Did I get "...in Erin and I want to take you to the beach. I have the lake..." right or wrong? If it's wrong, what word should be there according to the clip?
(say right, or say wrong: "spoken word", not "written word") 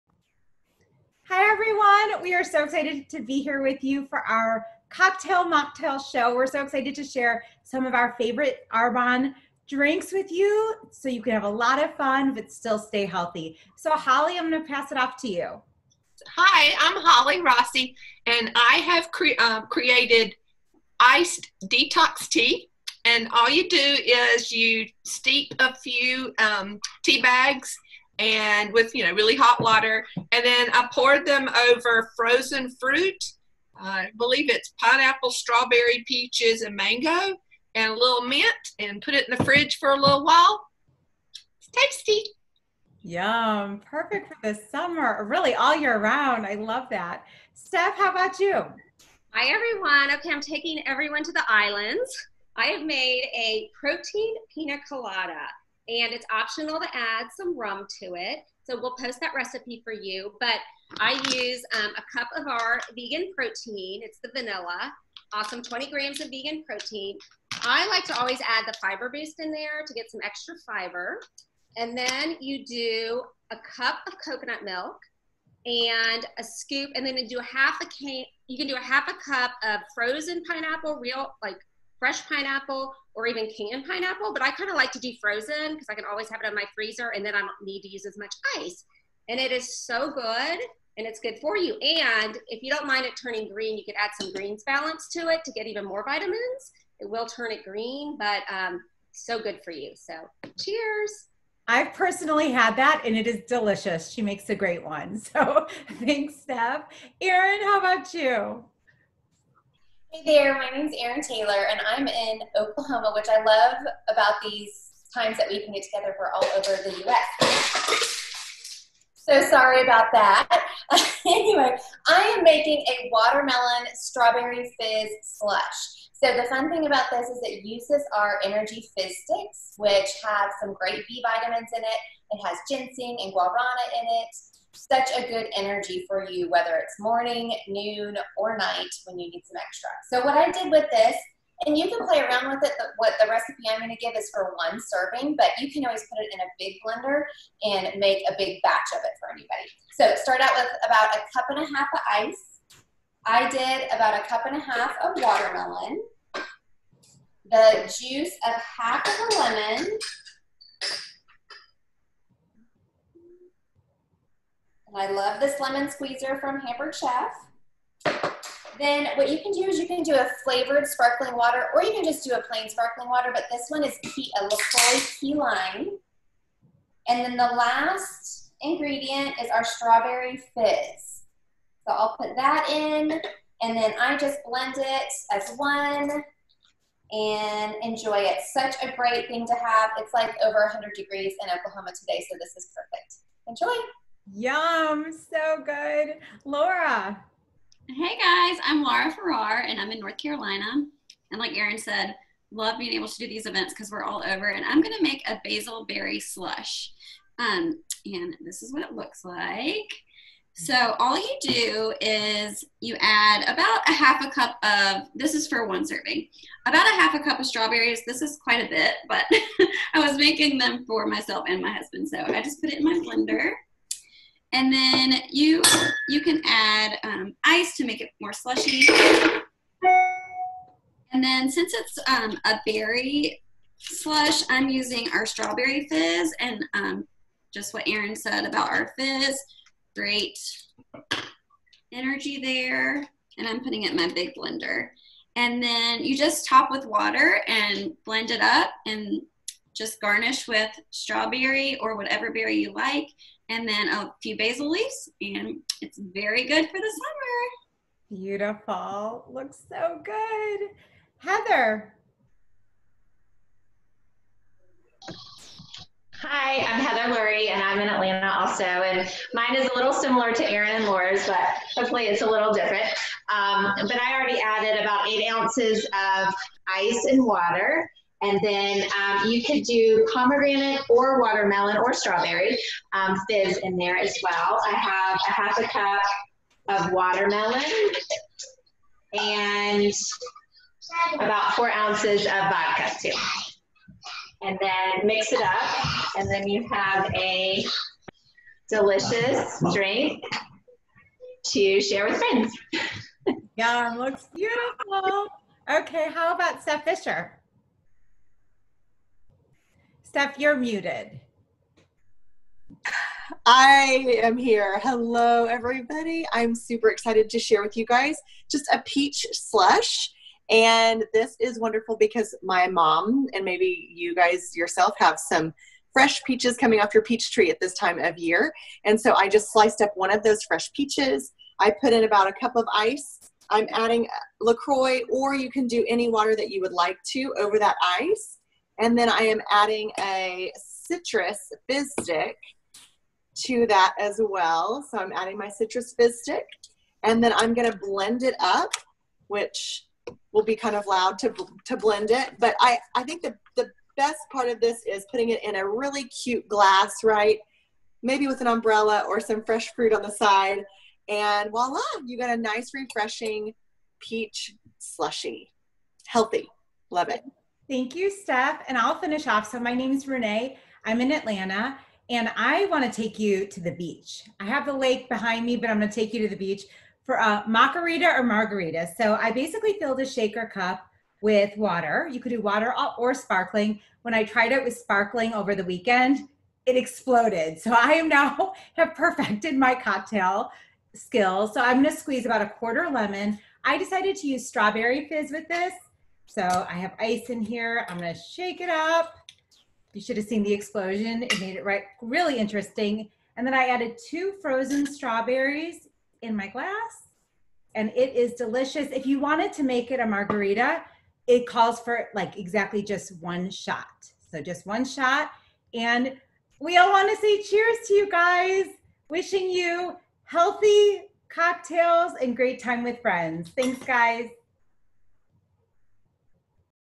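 wrong: "Atlanta", not "Erin".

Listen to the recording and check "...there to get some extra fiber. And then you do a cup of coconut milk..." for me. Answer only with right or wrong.
right.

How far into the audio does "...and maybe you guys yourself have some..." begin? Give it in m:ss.
5:23.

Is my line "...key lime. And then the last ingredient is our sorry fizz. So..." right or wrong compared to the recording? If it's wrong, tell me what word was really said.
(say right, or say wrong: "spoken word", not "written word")
wrong: "strawberry", not "sorry".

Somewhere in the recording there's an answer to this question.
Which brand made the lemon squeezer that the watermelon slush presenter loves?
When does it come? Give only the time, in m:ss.
2:46.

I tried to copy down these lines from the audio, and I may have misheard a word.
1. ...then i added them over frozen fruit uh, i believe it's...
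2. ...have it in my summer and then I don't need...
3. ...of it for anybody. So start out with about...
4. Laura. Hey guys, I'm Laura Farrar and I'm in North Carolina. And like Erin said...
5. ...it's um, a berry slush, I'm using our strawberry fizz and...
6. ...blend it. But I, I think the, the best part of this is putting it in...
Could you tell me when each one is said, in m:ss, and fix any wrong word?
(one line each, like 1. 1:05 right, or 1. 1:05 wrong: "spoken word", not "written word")
1. 0:30 wrong: "poured", not "added"
2. 1:26 wrong: "freezer", not "summer"
3. 2:28 right
4. 3:16 right
5. 3:51 right
6. 5:51 right.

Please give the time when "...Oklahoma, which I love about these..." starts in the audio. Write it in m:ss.
1:52.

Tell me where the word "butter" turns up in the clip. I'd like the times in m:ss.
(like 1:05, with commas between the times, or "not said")
not said.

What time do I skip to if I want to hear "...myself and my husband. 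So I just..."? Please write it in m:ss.
3:41.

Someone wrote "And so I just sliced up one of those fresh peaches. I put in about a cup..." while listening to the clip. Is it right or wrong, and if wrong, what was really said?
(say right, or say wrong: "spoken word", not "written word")
right.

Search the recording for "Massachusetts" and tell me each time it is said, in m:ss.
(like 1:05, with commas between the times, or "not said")
not said.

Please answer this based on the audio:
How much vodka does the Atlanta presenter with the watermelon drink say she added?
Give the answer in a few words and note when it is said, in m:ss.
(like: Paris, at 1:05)
4 ounces, at 4:51.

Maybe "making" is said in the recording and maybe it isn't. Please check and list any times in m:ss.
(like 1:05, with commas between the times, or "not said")
2:02, 3:40.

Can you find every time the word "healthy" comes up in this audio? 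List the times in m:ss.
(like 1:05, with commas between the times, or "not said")
0:13, 6:06, 7:00.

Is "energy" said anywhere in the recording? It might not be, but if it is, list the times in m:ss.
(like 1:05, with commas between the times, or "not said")
2:08, 2:15, 4:01.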